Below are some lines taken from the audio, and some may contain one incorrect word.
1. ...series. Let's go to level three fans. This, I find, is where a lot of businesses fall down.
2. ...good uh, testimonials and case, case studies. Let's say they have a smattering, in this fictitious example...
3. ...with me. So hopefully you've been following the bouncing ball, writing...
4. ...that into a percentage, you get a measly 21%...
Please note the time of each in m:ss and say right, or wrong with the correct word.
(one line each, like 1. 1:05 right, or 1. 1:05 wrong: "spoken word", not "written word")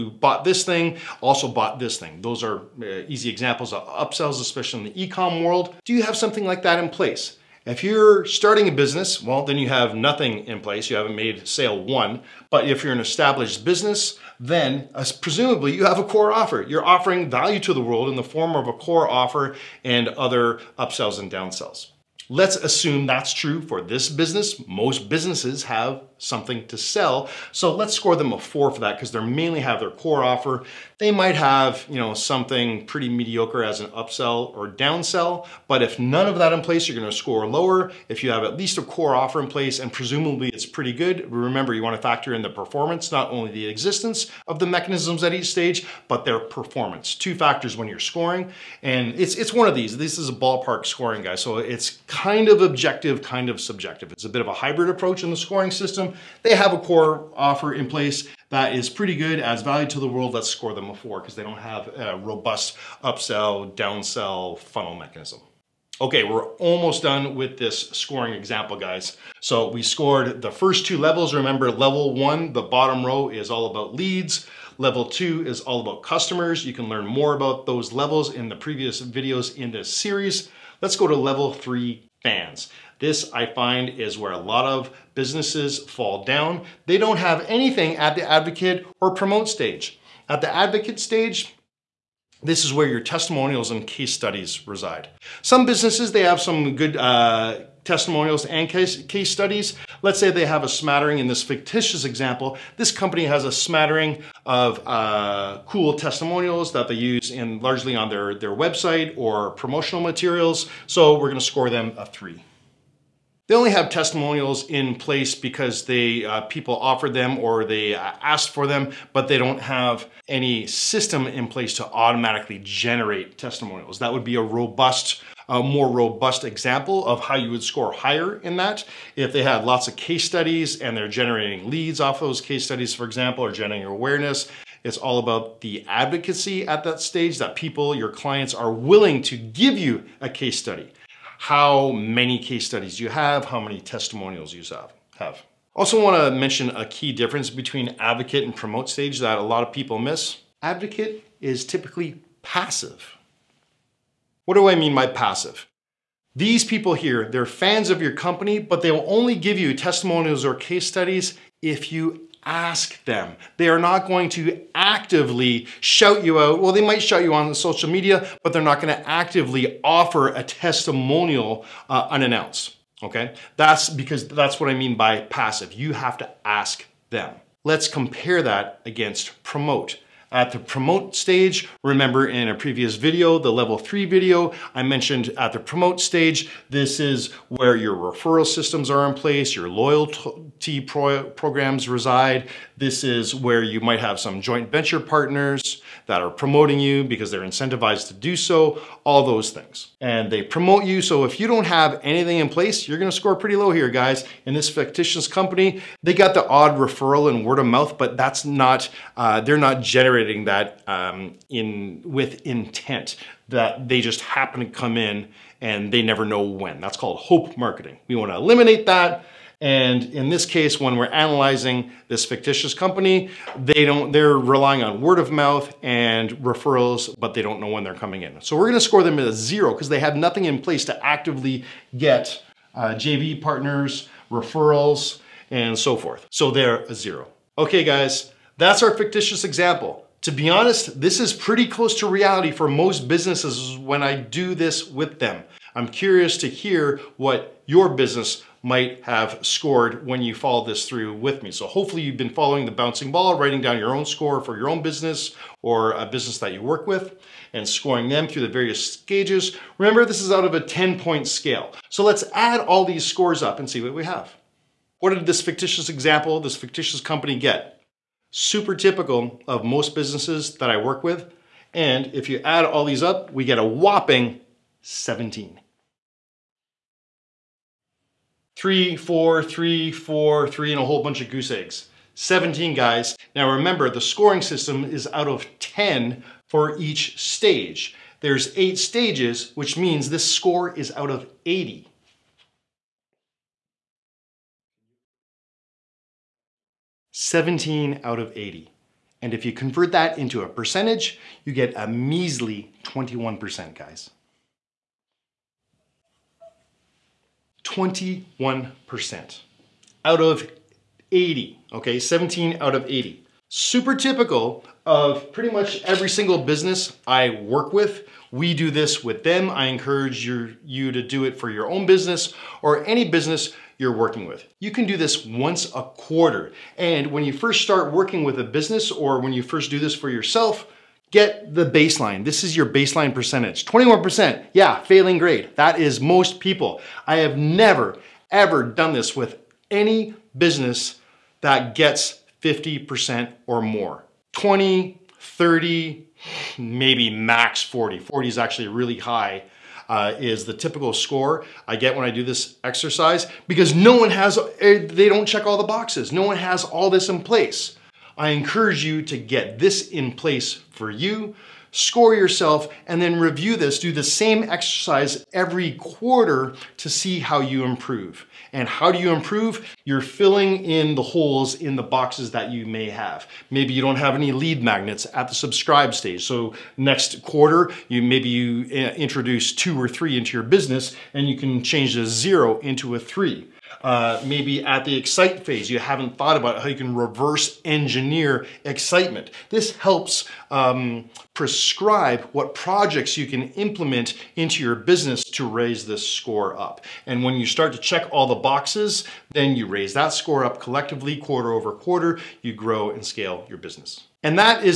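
1. 1:19 right
2. 1:36 right
3. 4:11 right
4. 4:59 right.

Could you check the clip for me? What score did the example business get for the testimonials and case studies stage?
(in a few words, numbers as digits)
3.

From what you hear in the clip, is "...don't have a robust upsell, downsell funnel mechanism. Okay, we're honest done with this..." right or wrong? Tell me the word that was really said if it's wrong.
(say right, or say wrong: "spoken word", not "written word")
wrong: "almost", not "honest".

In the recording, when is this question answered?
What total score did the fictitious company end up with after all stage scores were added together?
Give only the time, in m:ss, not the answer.
4:33.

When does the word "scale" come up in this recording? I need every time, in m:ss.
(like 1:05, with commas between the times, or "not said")
4:21, 6:43.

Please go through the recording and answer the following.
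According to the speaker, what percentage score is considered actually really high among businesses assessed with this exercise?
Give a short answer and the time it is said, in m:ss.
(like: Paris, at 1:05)
40%, at 5:48.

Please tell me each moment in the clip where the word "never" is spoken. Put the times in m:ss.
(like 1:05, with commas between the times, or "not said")
3:36, 5:37.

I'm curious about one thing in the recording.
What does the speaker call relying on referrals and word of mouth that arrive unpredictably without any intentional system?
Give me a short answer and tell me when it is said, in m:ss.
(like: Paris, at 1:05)
hope marketing, at 3:37.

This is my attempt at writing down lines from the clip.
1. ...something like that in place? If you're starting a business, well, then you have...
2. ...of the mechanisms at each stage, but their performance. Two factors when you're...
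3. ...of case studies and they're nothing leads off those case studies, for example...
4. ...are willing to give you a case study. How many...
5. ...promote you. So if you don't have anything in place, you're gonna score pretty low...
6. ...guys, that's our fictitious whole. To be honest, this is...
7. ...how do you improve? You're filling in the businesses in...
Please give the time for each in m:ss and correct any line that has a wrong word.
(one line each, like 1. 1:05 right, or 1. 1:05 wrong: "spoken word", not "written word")
1. 0:06 right
2. 0:44 right
3. 2:09 wrong: "generating", not "nothing"
4. 2:18 right
5. 3:20 right
6. 3:57 wrong: "example", not "whole"
7. 6:08 wrong: "holes", not "businesses".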